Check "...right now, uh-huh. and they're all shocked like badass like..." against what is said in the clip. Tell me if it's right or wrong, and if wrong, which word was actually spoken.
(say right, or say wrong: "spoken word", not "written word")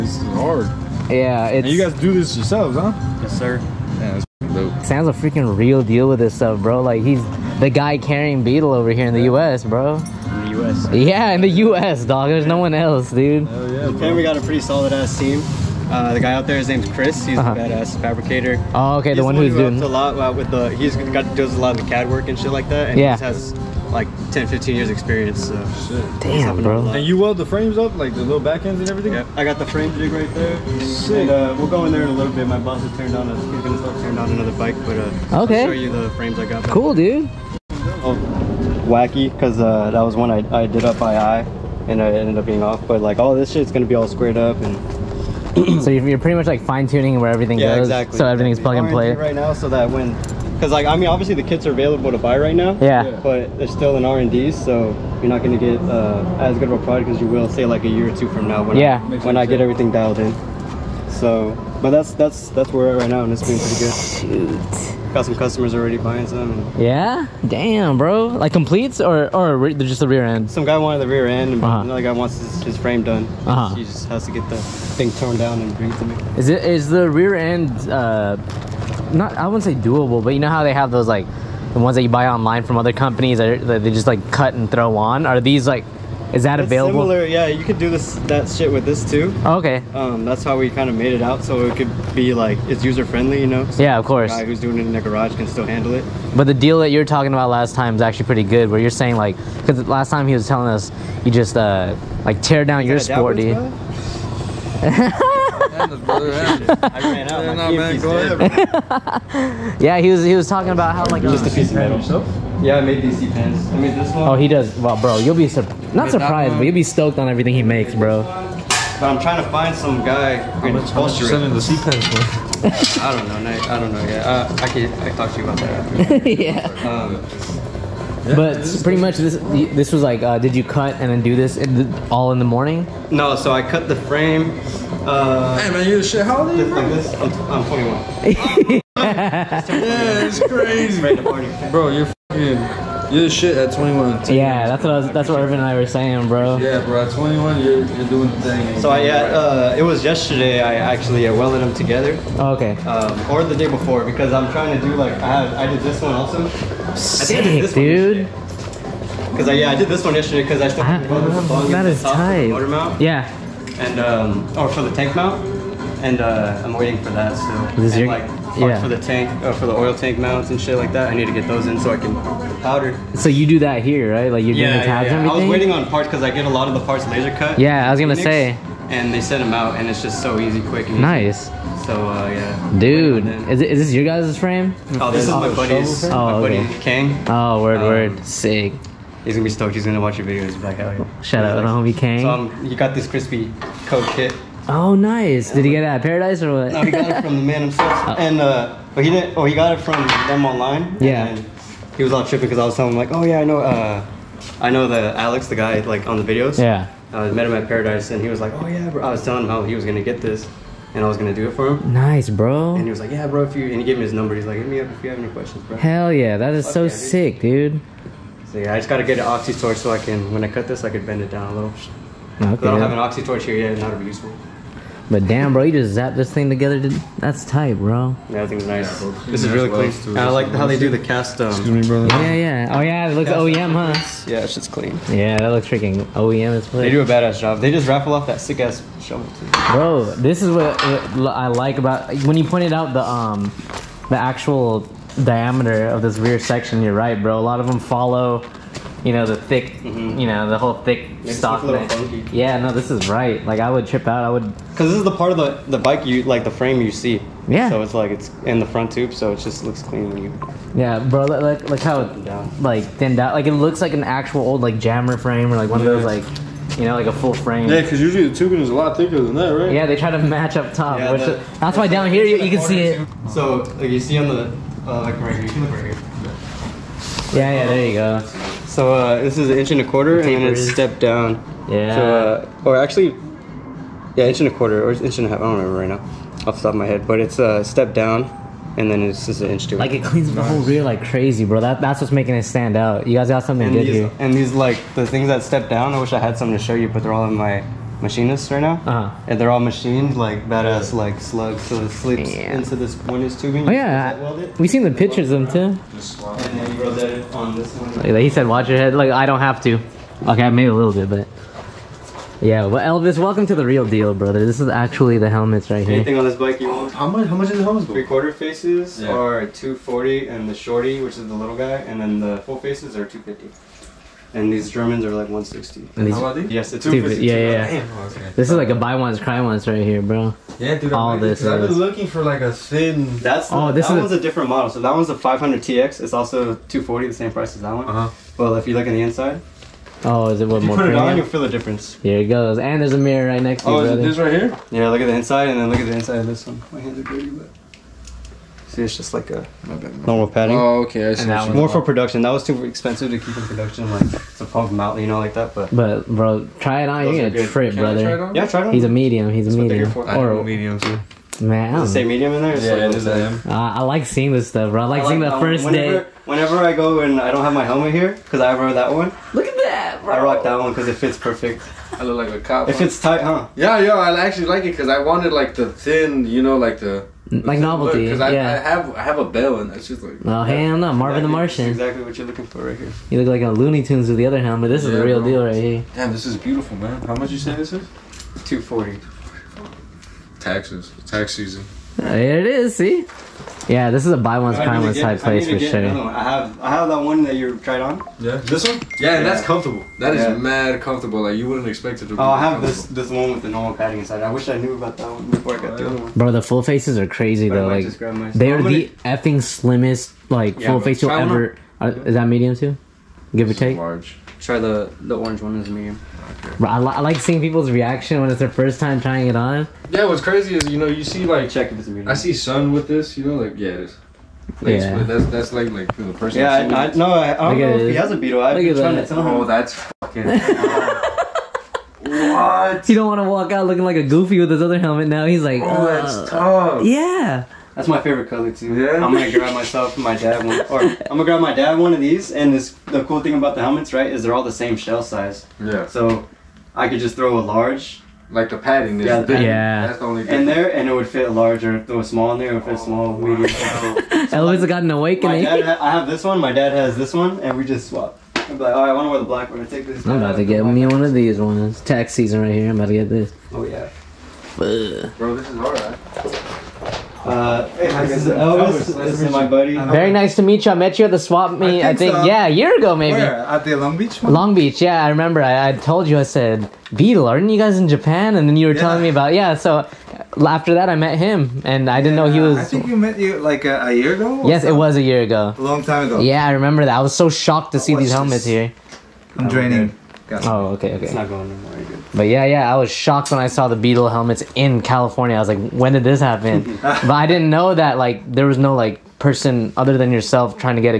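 wrong: "machined", not "shocked".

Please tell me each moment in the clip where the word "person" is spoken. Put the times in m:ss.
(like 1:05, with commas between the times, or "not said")
7:06, 8:19.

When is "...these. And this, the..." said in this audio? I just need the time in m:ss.
7:22.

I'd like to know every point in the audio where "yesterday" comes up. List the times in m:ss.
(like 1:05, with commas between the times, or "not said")
2:30, 2:40.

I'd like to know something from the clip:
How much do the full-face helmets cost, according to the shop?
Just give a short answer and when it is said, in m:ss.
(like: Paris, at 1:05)
$250, at 5:23.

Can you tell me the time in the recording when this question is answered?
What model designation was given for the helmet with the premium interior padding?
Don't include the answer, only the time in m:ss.
5:35.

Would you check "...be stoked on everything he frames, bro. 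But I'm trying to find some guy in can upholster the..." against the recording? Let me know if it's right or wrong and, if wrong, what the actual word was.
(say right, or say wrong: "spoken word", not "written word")
wrong: "makes", not "frames".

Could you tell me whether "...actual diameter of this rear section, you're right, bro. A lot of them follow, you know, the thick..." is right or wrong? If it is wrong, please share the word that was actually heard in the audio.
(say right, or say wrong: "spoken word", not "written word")
right.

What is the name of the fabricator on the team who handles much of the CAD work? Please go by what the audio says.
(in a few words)
Chris.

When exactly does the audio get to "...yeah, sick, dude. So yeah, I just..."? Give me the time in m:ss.
3:36.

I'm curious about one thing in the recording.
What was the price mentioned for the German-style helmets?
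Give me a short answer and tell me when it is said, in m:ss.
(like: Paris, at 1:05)
$160, at 5:25.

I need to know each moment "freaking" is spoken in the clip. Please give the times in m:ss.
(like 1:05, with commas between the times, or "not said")
0:05, 3:55.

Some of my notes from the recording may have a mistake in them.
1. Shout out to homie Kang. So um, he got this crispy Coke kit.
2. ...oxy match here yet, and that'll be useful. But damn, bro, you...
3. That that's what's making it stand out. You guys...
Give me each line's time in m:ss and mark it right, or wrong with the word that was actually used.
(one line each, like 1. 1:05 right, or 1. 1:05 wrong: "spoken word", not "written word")
1. 3:11 right
2. 3:42 wrong: "torch", not "match"
3. 4:51 right.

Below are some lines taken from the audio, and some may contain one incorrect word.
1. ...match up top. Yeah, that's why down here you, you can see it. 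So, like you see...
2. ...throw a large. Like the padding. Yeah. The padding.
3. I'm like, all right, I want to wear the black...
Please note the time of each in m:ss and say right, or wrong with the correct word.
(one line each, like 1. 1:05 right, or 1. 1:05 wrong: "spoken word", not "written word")
1. 4:30 right
2. 7:27 right
3. 7:38 right.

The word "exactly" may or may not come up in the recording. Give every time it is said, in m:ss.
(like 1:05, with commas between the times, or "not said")
0:47, 6:21.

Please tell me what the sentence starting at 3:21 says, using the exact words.
he was all tripping because I was telling him like, oh yeah, I know.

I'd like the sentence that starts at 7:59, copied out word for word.
So after that, I met him, and I didn't know he was.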